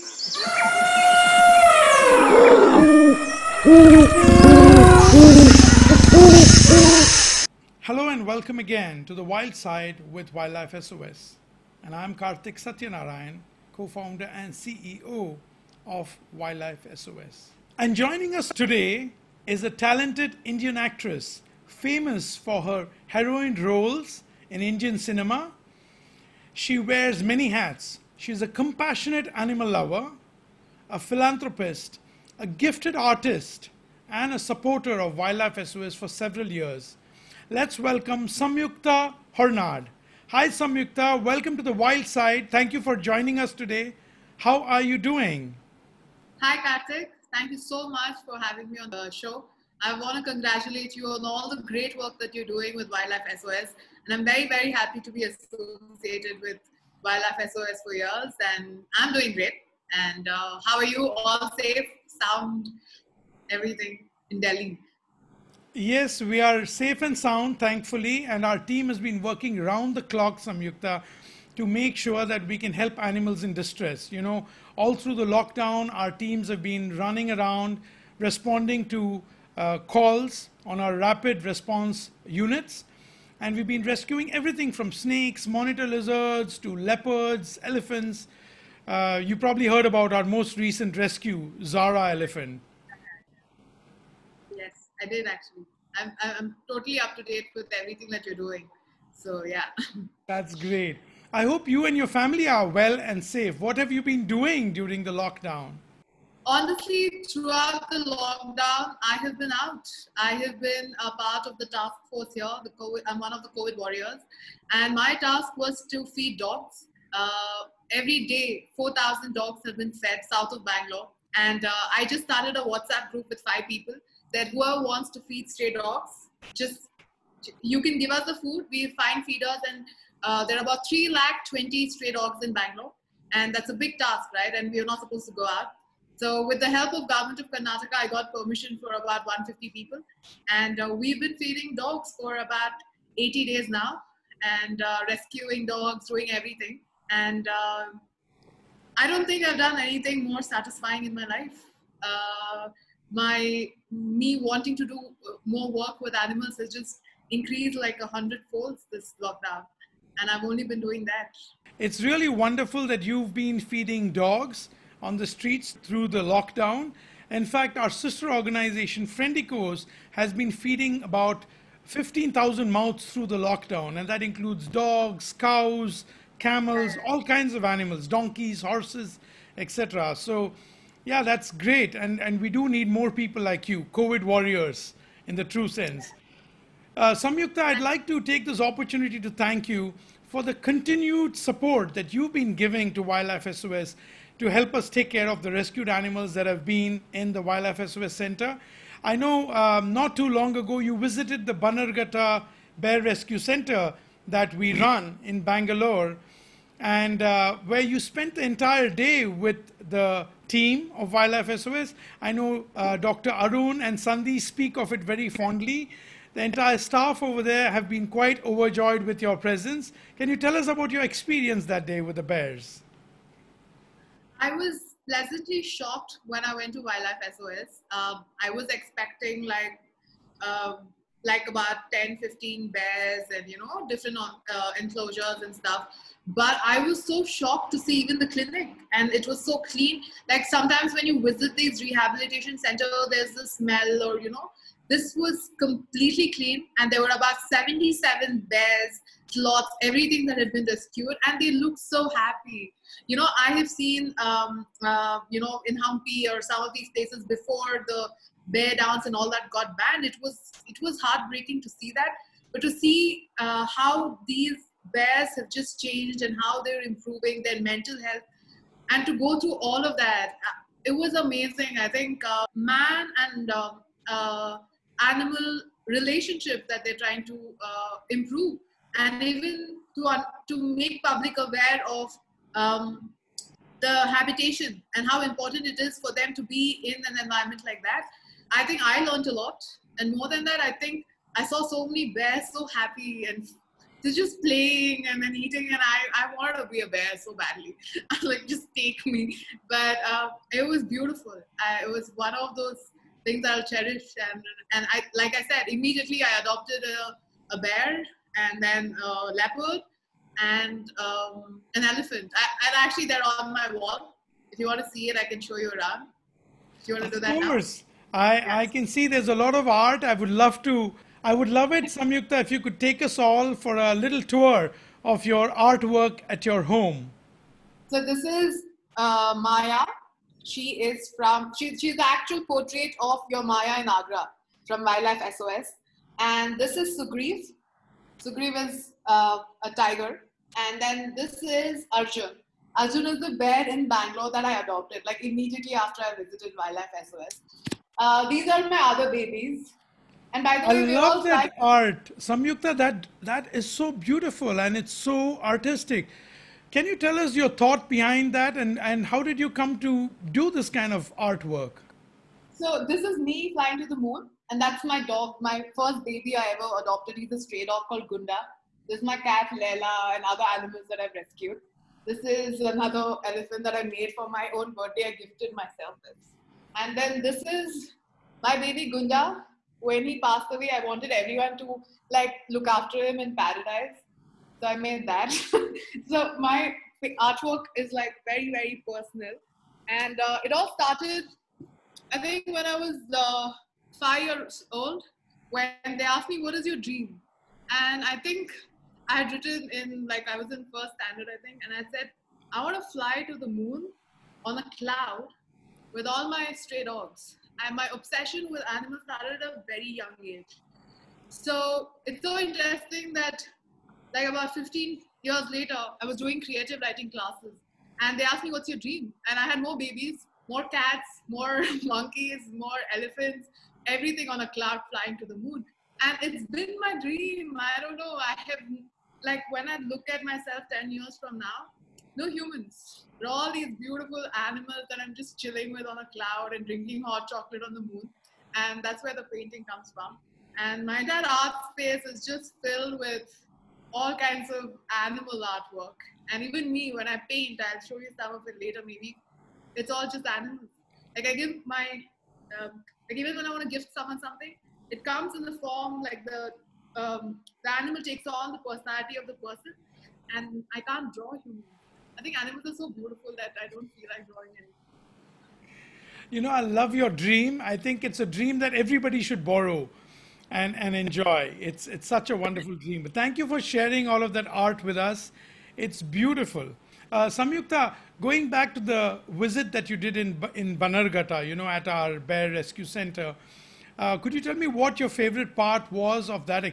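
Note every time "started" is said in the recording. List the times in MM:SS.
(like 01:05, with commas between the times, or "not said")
02:02, 06:30, 06:49.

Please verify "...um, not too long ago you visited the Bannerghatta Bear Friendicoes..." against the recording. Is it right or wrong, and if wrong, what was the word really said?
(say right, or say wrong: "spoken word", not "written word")
wrong: "Rescue", not "Friendicoes".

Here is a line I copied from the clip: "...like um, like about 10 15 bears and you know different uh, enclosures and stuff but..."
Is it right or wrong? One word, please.
right.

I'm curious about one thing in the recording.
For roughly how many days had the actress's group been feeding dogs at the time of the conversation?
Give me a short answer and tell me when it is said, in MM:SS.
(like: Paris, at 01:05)
80, at 02:23.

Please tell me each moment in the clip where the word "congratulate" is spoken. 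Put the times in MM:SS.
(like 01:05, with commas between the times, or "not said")
00:50.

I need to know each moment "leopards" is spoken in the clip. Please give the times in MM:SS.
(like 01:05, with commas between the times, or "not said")
01:26, 05:09.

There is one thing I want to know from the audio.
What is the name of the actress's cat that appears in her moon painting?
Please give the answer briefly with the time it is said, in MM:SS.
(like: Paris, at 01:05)
Leila, at 06:09.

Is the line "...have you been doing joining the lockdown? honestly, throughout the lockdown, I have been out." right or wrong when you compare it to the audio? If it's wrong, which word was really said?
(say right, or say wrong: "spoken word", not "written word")
wrong: "during", not "joining".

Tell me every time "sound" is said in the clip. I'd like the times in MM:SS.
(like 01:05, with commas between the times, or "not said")
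01:02, 01:07.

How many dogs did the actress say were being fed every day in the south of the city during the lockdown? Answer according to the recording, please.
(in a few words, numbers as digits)
4,000.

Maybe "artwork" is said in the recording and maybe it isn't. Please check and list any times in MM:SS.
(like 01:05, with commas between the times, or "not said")
05:25, 06:01, 06:27, 07:25.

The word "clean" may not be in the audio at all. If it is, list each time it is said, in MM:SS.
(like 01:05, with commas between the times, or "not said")
03:59, 04:06.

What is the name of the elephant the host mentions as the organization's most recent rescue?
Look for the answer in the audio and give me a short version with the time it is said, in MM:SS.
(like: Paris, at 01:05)
Zara, at 01:31.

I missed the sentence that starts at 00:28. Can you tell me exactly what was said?
She's a compassionate animal lover, a philanthropist, a gifted artist and a supporter of Wildlife SOS for several years.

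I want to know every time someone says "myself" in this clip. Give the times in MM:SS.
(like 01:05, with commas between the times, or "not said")
06:15, 07:10.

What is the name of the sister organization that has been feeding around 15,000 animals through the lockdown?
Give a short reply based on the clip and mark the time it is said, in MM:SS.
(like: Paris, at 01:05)
Friendicoes, at 02:49.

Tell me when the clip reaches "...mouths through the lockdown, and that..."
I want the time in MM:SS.
02:52.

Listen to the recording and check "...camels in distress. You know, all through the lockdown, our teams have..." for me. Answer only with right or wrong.
wrong.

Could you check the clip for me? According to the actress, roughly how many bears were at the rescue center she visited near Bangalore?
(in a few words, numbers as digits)
77.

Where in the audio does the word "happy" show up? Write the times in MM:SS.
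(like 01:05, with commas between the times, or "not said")
00:54, 04:12, 04:52.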